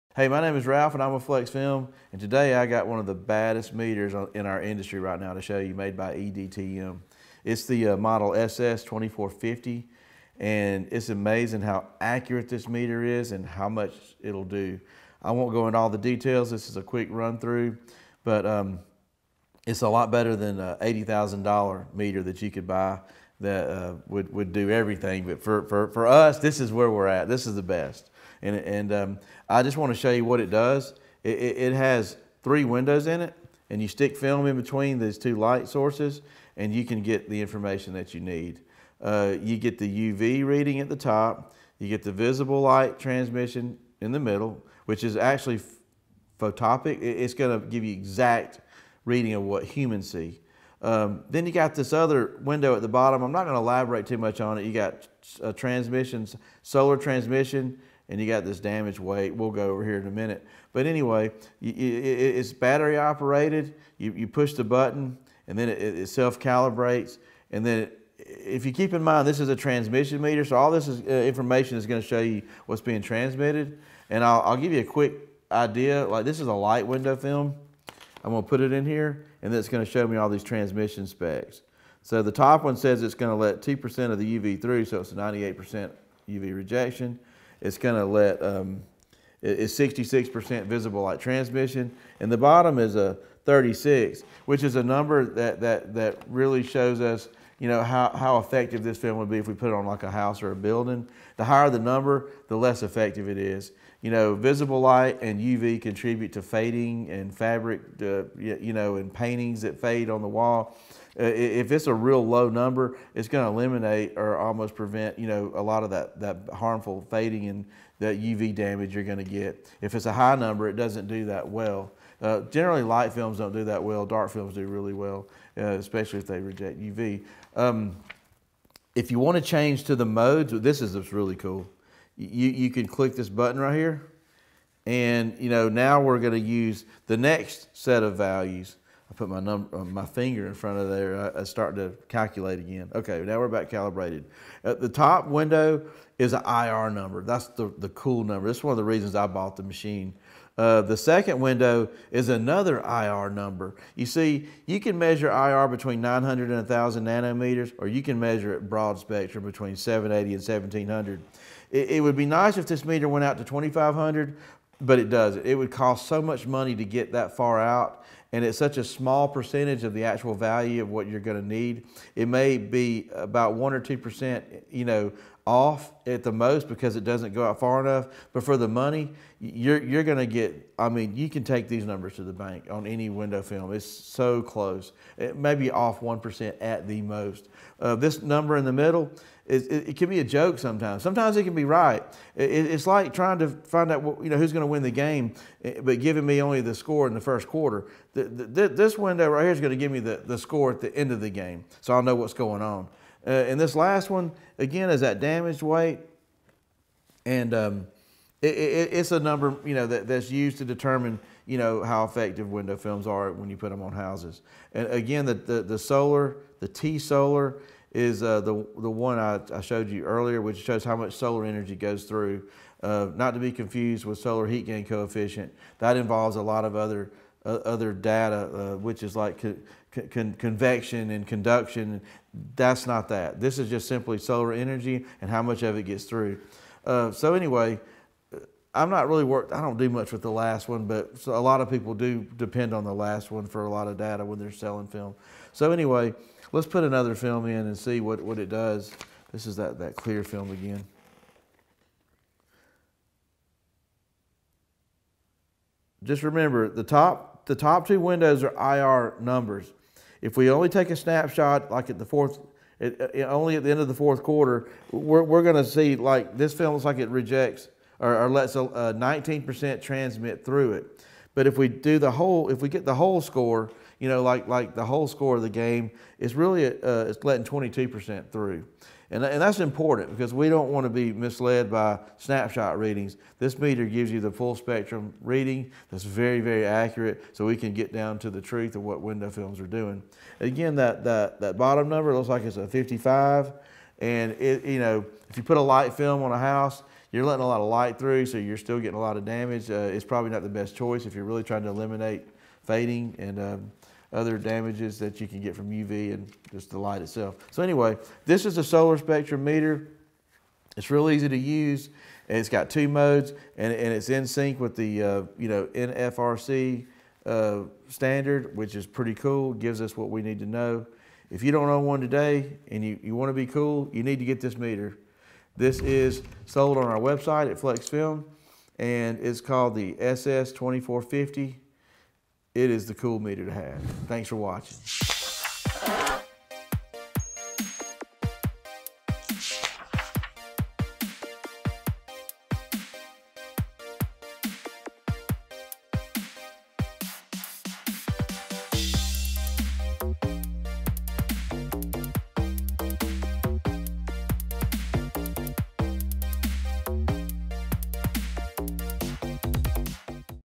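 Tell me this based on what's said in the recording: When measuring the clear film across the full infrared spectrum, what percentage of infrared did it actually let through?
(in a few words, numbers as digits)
22%.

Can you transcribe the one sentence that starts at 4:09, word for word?
This is that, that clear film again.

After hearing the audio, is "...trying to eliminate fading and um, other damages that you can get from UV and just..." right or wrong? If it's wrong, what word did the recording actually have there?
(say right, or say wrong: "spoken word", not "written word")
right.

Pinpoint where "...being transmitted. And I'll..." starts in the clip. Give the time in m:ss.
1:12.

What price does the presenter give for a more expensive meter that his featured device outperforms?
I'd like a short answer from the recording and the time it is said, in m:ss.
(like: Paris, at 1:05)
$80,000, at 0:20.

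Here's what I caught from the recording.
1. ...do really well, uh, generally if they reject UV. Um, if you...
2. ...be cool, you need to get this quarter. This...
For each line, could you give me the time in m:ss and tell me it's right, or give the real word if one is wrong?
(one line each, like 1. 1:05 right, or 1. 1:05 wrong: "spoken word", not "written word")
1. 2:04 wrong: "especially", not "generally"
2. 5:23 wrong: "meter", not "quarter".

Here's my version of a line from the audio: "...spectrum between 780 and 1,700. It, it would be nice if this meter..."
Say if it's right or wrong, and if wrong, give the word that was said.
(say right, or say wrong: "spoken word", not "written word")
right.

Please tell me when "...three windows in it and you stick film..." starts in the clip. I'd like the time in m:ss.
0:32.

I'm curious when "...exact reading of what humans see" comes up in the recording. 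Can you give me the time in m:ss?
0:47.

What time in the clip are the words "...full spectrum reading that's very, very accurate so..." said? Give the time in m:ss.
4:44.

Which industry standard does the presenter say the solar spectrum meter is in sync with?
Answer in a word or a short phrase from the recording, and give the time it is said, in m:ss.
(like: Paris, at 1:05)
NFRC, at 5:15.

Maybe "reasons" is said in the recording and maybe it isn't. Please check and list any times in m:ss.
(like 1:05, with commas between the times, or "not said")
2:28.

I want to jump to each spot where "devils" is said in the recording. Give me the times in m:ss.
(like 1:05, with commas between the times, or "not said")
not said.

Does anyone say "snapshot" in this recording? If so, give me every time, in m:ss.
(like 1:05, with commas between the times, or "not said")
4:20, 4:42.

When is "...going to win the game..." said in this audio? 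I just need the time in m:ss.
3:14.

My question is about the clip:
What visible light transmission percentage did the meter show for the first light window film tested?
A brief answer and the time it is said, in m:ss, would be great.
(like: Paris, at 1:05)
66%, at 1:29.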